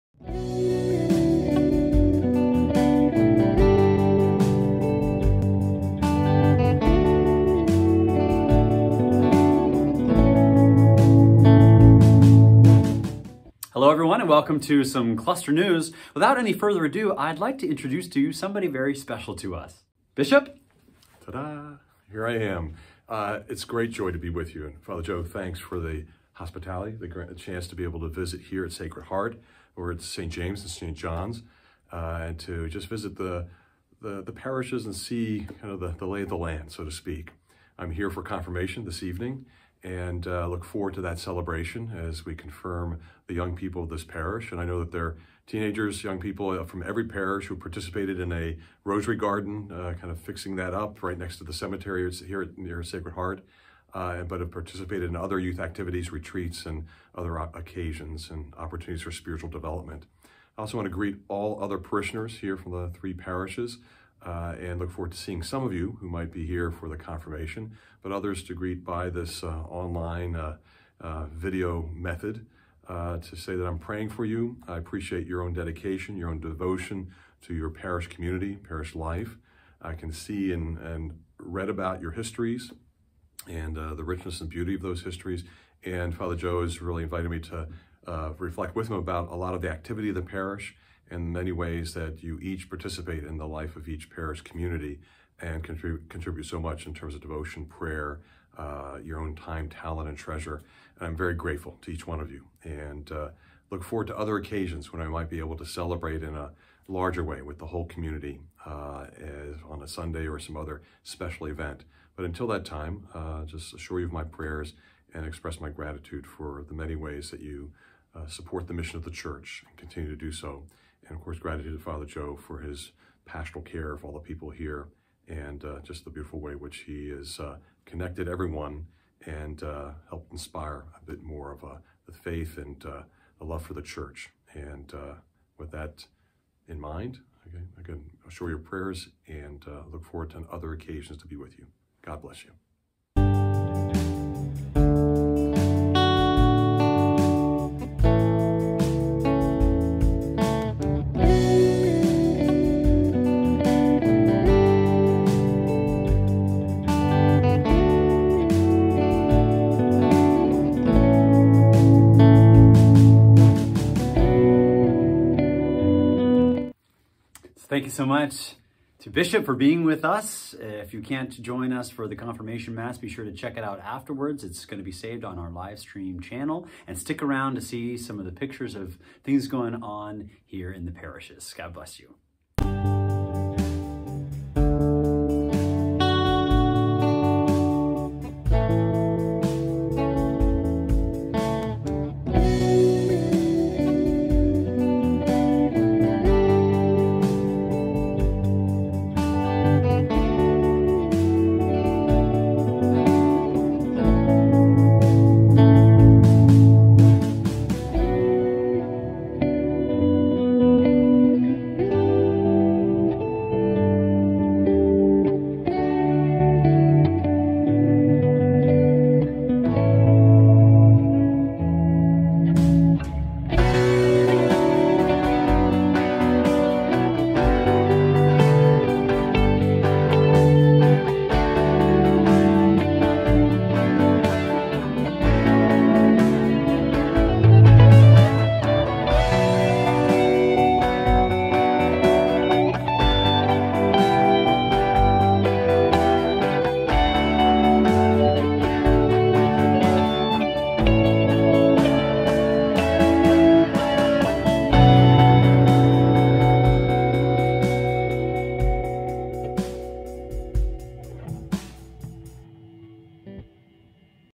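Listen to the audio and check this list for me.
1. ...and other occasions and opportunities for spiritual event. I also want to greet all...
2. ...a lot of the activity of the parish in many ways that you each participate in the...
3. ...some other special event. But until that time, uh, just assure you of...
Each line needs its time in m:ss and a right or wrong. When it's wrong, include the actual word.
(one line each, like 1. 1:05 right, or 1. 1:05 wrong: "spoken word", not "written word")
1. 0:56 wrong: "development", not "event"
2. 1:29 right
3. 1:50 right.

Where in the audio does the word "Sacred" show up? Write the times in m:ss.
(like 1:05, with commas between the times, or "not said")
0:28, 0:52.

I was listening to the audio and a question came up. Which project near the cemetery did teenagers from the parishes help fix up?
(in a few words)
Rosary garden.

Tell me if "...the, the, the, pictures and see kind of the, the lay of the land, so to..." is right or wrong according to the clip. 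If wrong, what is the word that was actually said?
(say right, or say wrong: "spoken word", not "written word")
wrong: "parishes", not "pictures".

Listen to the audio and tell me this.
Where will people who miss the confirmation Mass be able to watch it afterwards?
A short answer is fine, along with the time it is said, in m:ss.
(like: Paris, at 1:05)
Live stream channel, at 2:55.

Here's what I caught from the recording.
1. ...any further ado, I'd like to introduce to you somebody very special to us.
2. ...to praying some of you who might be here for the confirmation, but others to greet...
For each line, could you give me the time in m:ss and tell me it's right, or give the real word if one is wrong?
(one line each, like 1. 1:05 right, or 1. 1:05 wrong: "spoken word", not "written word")
1. 0:16 right
2. 1:05 wrong: "seeing", not "praying".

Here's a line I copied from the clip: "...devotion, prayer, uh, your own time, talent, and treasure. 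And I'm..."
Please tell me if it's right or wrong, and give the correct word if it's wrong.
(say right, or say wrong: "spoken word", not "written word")
right.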